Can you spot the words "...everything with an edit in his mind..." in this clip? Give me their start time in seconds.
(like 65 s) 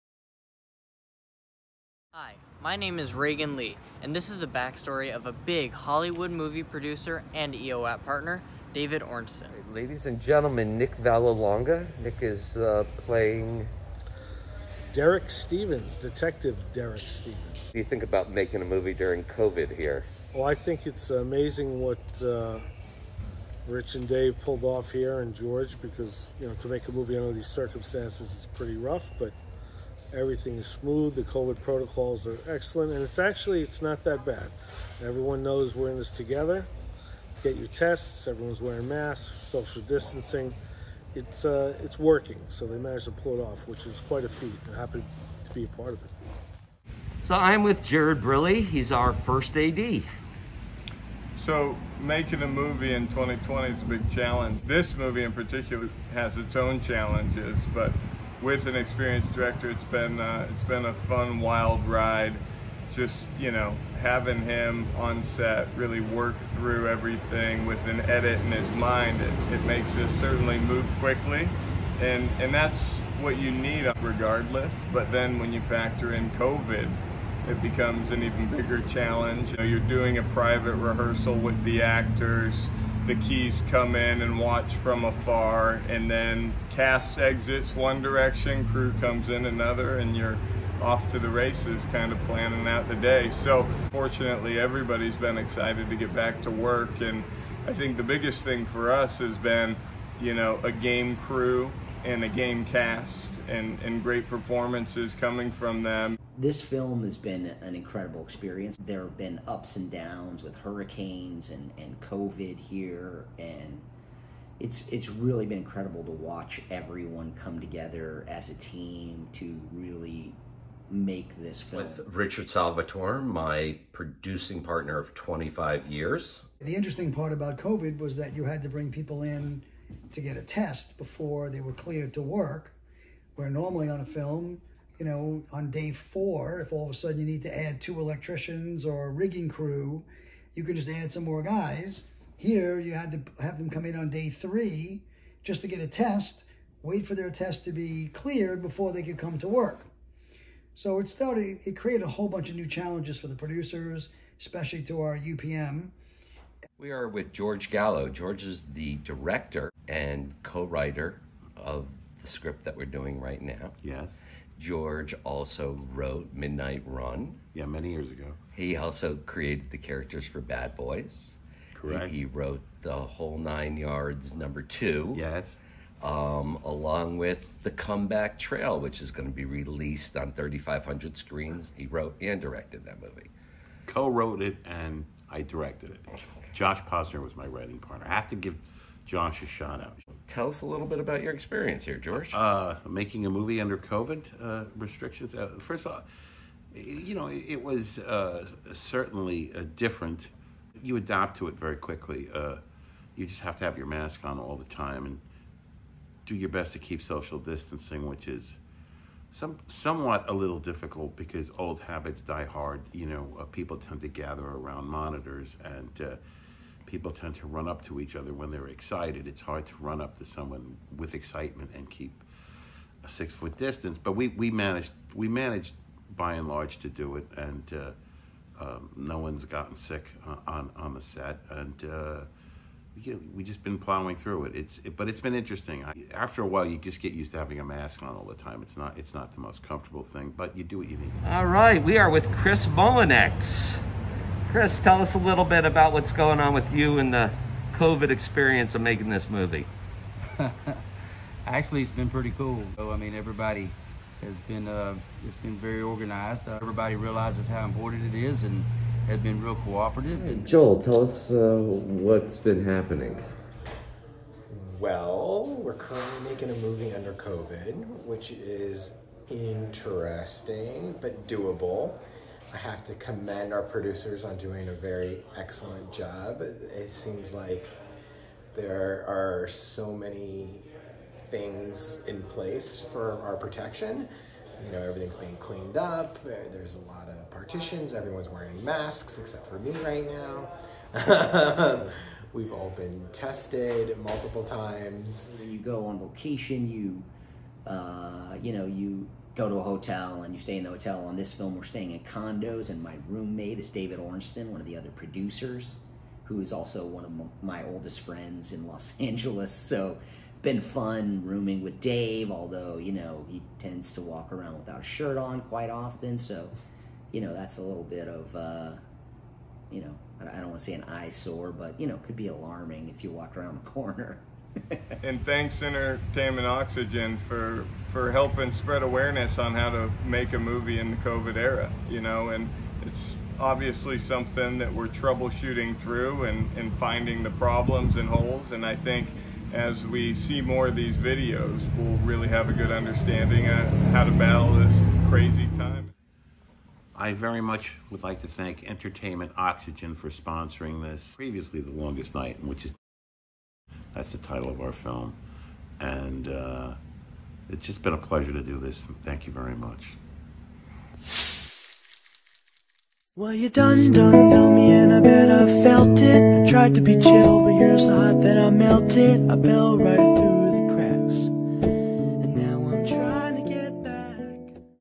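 66 s.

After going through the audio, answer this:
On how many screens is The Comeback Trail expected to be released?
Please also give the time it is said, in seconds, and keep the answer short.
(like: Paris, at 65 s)
3,500, at 180 s.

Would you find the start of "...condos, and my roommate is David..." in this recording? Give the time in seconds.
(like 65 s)
302 s.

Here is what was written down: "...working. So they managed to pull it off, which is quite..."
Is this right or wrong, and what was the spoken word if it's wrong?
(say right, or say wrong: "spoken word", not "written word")
right.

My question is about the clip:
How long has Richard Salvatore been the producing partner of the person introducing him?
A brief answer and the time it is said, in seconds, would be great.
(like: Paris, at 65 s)
25 years, at 125 s.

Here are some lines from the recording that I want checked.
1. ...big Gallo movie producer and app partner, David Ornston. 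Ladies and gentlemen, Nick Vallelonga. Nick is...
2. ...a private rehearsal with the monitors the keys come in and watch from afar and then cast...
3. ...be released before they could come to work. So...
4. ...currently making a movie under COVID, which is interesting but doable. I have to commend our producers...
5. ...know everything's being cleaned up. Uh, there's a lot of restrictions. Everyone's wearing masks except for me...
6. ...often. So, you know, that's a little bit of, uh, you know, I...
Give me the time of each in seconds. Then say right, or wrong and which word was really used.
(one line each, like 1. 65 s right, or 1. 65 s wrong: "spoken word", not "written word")
1. 5 s wrong: "Hollywood", not "Gallo"
2. 80 s wrong: "actors", not "monitors"
3. 147 s wrong: "cleared", not "released"
4. 265 s right
5. 284 s wrong: "partitions", not "restrictions"
6. 315 s right.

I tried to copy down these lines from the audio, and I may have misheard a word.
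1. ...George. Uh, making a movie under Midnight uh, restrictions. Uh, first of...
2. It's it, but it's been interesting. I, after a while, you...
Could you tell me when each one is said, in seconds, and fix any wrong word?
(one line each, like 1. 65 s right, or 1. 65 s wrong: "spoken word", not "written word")
1. 191 s wrong: "COVID", not "Midnight"
2. 234 s right.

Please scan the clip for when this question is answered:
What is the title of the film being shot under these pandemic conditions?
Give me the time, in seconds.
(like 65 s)
351 s.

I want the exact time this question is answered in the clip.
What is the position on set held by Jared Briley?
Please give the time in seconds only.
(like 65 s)
49 s.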